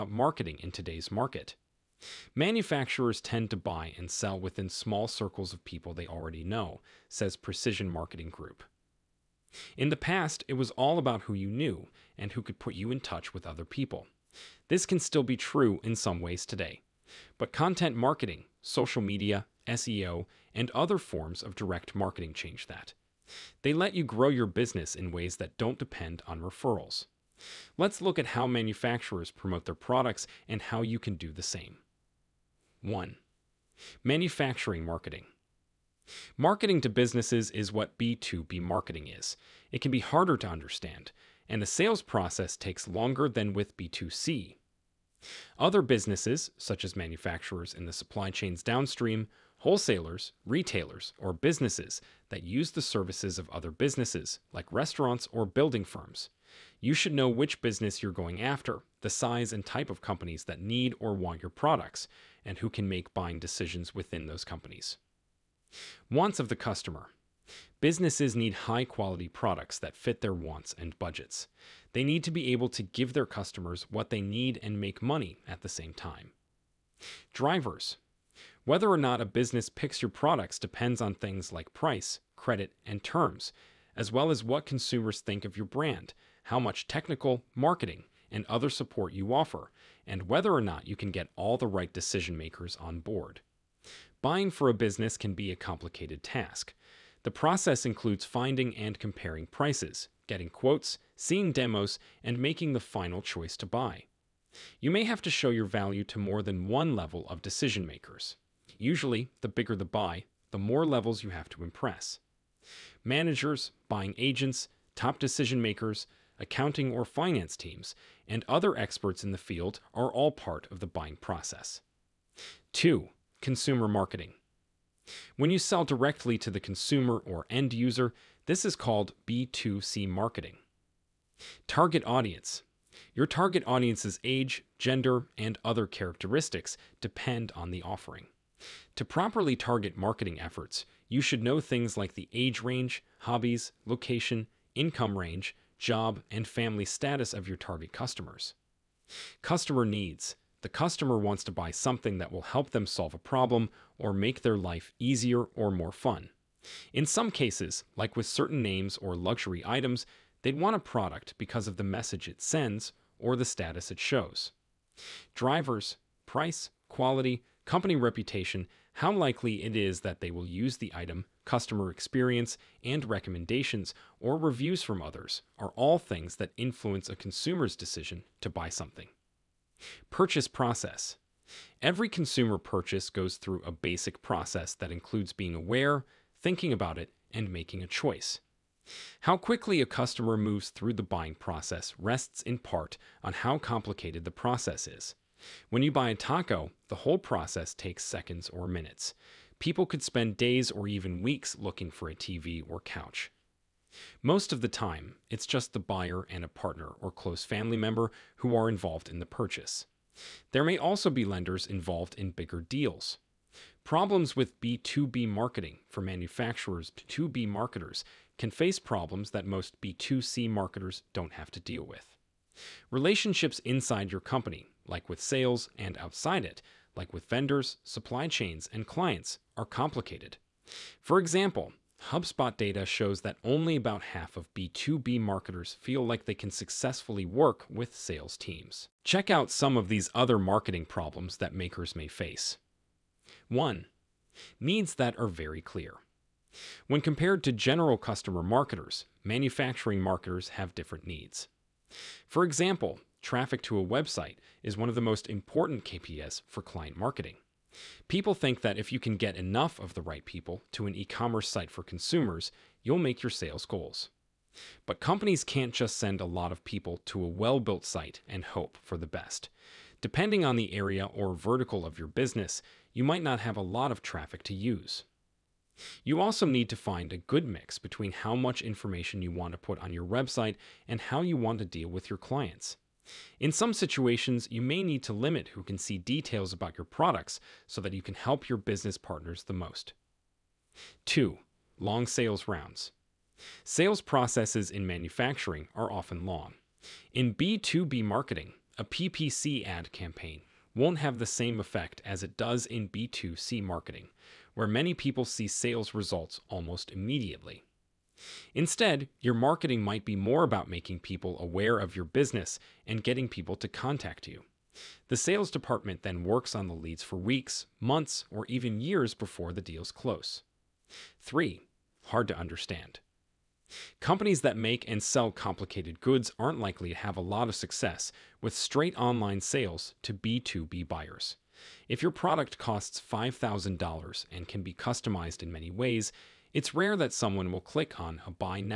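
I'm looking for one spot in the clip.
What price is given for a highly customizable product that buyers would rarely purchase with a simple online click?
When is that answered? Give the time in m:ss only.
5:33.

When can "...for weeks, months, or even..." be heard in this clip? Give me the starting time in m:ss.
5:17.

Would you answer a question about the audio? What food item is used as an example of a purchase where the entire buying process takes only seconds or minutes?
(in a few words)
taco.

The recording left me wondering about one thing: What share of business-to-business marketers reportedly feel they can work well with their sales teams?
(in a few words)
about half.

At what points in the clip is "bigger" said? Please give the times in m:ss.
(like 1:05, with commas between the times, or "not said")
1:49, 3:32.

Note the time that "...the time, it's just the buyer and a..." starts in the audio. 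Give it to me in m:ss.
3:24.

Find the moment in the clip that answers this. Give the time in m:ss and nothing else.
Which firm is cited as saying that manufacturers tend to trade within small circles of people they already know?
0:07.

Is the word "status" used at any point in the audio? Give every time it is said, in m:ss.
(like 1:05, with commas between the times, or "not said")
2:26, 2:43.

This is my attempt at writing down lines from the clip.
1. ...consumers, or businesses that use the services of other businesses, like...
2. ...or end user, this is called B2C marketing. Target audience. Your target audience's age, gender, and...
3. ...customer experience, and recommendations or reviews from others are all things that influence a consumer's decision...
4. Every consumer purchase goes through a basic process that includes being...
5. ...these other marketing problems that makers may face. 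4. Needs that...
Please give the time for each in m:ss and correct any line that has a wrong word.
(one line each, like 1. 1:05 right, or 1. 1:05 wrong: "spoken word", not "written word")
1. 0:50 wrong: "retailers", not "consumers"
2. 2:07 right
3. 2:51 right
4. 3:01 right
5. 3:59 wrong: "1", not "4".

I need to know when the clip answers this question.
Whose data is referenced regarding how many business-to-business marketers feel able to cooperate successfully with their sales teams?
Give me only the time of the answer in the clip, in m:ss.
3:52.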